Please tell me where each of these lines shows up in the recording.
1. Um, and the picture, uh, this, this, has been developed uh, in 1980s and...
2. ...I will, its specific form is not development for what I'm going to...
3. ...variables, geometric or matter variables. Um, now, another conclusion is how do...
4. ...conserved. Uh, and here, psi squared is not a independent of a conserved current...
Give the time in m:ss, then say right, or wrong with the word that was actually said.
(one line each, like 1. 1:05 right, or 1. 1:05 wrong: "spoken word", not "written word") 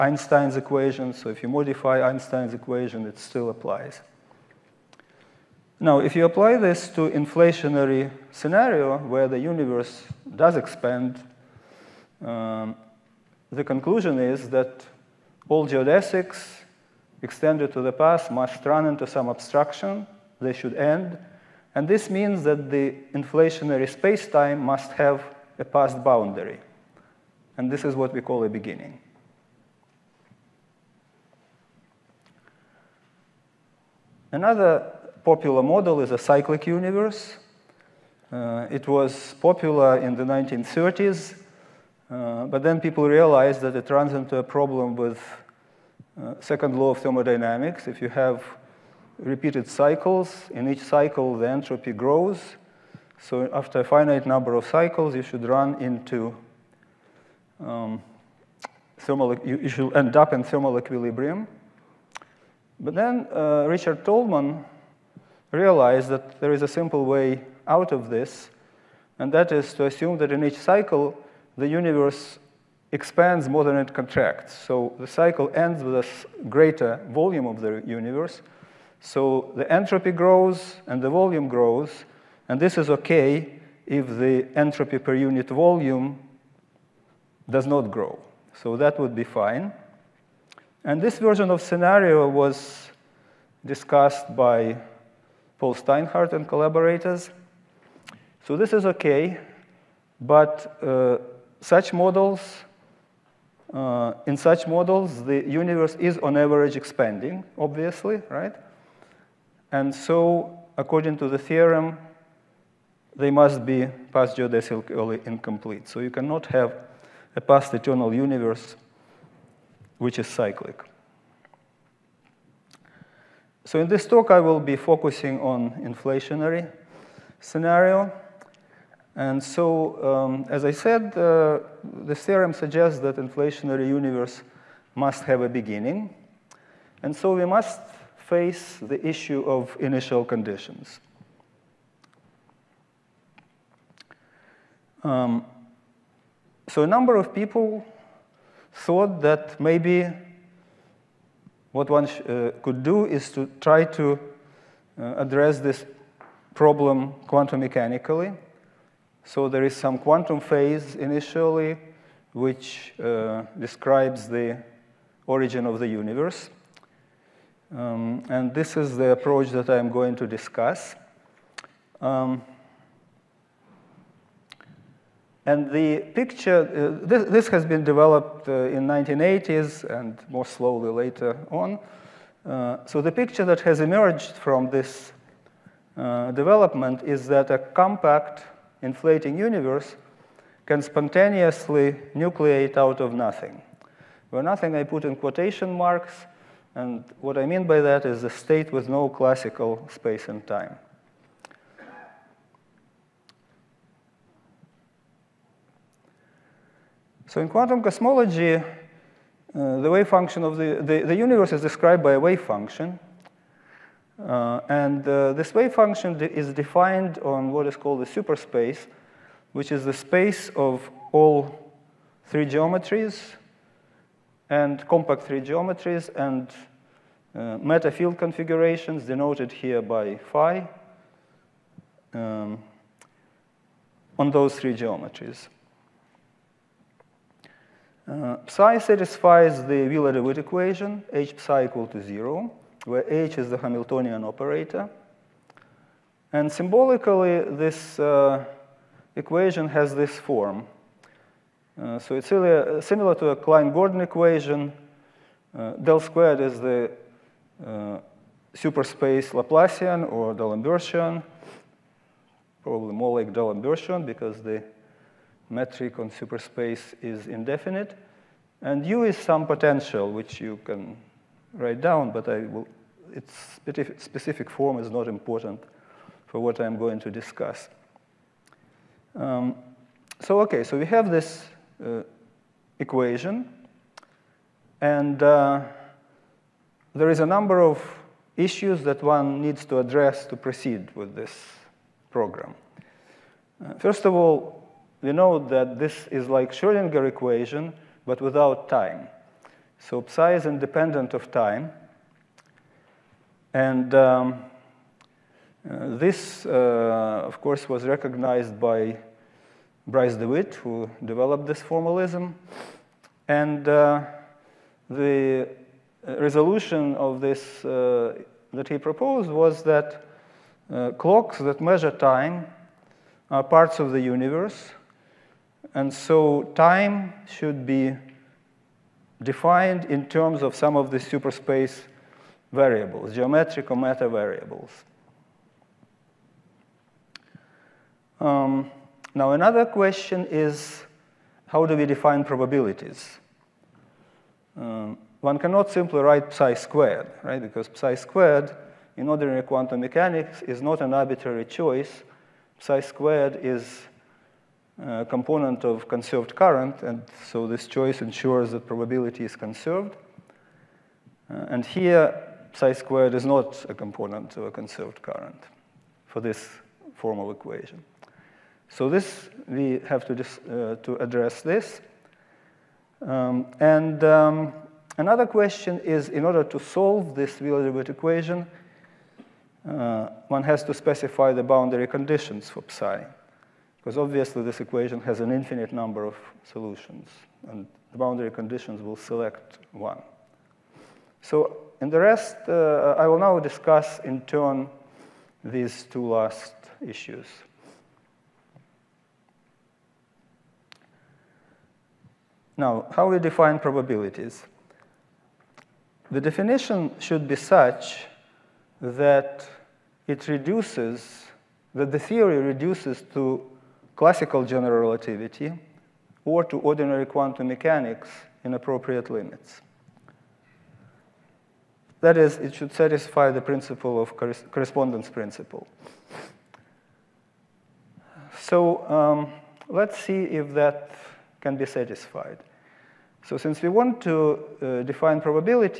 1. 2:52 right
2. 4:32 wrong: "important", not "development"
3. 5:32 wrong: "question", not "conclusion"
4. 5:59 wrong: "component", not "independent".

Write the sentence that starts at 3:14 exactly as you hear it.
Where nothing I put in quotation marks, and what I mean by that is a state with no classical space and time.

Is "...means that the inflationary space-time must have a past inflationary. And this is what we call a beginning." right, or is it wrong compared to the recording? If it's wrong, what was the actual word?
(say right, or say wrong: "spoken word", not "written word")
wrong: "boundary", not "inflationary".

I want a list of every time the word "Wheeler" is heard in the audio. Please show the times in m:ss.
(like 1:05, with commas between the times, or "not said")
3:59, 6:17.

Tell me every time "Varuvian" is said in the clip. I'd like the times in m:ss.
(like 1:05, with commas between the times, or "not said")
not said.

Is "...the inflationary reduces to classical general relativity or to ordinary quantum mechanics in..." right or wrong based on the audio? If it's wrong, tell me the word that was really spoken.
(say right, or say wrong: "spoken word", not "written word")
wrong: "theory", not "inflationary".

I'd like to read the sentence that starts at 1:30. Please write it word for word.
And this version of scenario was discussed by Paul Steinhardt and collaborators.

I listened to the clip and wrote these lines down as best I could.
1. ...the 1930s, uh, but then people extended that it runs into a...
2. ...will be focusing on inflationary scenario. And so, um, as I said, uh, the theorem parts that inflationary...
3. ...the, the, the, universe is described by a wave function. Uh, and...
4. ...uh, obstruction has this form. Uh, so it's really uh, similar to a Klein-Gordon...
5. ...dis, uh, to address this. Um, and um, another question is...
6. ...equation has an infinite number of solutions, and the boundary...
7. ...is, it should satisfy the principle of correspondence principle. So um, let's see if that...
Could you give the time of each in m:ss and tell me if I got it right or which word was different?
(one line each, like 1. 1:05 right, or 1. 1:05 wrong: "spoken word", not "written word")
1. 0:40 wrong: "realized", not "extended"
2. 2:04 wrong: "suggests", not "parts"
3. 3:30 right
4. 4:07 wrong: "equation", not "obstruction"
5. 6:10 right
6. 6:24 right
7. 7:02 right.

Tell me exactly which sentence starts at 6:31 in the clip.
So in the rest, uh, I will now discuss in turn these two last issues.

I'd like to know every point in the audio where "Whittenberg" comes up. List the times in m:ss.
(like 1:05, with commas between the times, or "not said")
not said.